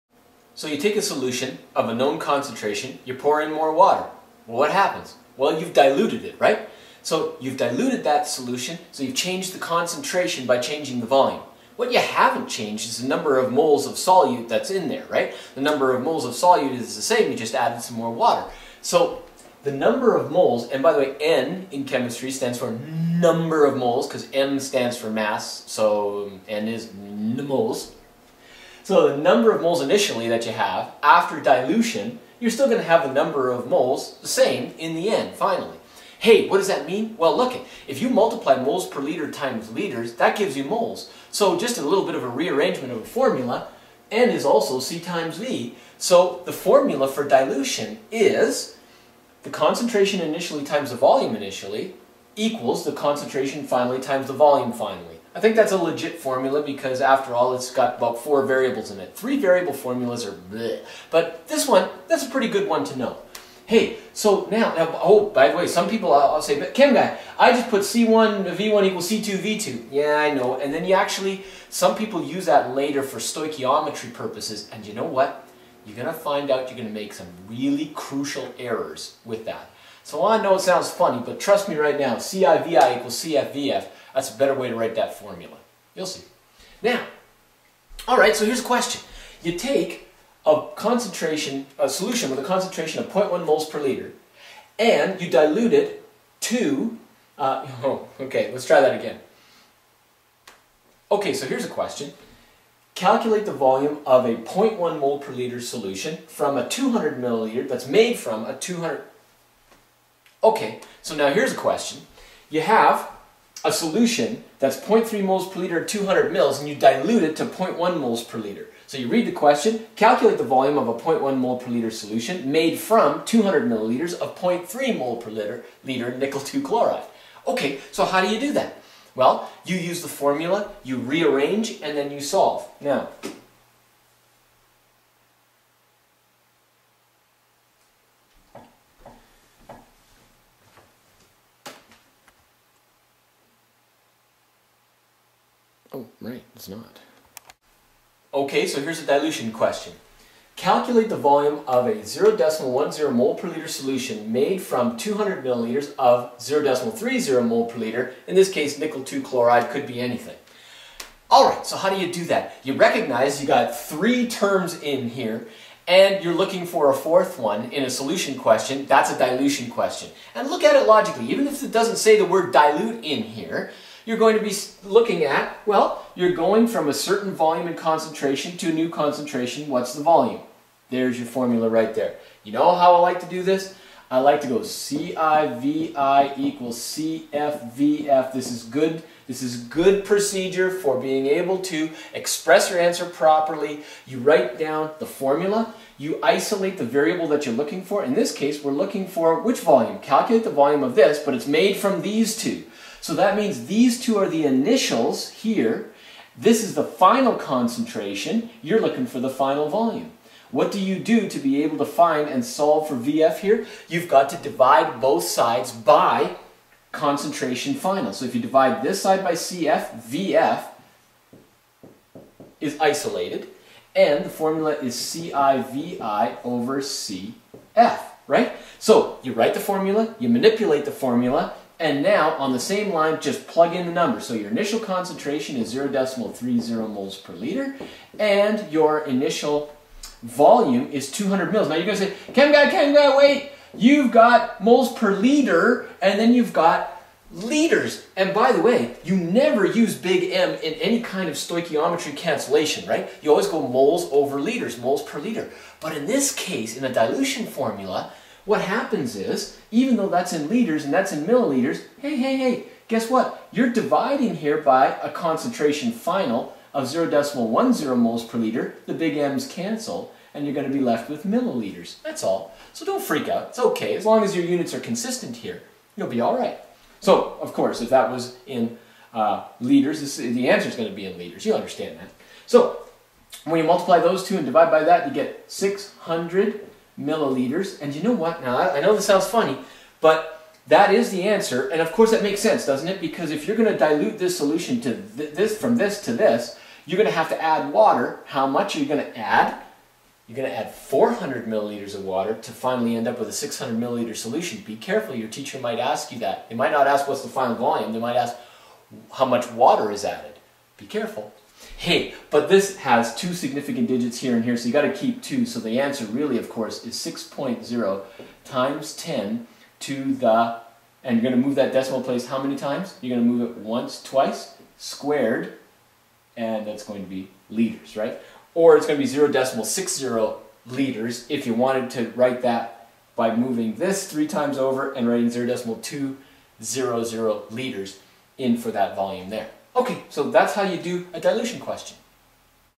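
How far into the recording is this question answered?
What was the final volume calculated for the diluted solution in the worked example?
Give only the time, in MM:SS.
04:45.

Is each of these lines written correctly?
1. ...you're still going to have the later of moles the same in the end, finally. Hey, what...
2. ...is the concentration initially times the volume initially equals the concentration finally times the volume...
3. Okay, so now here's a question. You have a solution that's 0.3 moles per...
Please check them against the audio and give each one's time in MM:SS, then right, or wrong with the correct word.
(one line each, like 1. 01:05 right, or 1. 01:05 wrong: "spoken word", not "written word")
1. 00:32 wrong: "number", not "later"
2. 00:48 right
3. 01:50 right.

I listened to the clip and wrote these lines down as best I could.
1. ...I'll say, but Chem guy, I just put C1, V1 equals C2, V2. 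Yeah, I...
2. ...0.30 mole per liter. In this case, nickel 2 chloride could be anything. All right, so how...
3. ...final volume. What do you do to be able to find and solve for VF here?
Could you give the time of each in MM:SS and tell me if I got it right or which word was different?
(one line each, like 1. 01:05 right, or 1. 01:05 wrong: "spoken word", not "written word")
1. 01:06 right
2. 02:36 right
3. 03:29 right.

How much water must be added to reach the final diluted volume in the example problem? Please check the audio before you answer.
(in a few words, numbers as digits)
400 milliliters.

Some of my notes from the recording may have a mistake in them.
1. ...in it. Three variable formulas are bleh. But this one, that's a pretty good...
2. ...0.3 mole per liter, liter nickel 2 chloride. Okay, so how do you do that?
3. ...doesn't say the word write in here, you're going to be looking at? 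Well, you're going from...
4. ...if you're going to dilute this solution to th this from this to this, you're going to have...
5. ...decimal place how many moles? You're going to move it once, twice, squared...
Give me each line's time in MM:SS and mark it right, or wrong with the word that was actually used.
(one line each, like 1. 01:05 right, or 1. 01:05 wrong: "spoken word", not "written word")
1. 00:58 right
2. 02:04 right
3. 02:51 wrong: "dilute", not "write"
4. 04:53 right
5. 05:21 wrong: "times", not "moles".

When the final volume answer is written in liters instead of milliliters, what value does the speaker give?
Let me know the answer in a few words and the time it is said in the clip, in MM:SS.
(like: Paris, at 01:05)
0.60 liters, at 05:29.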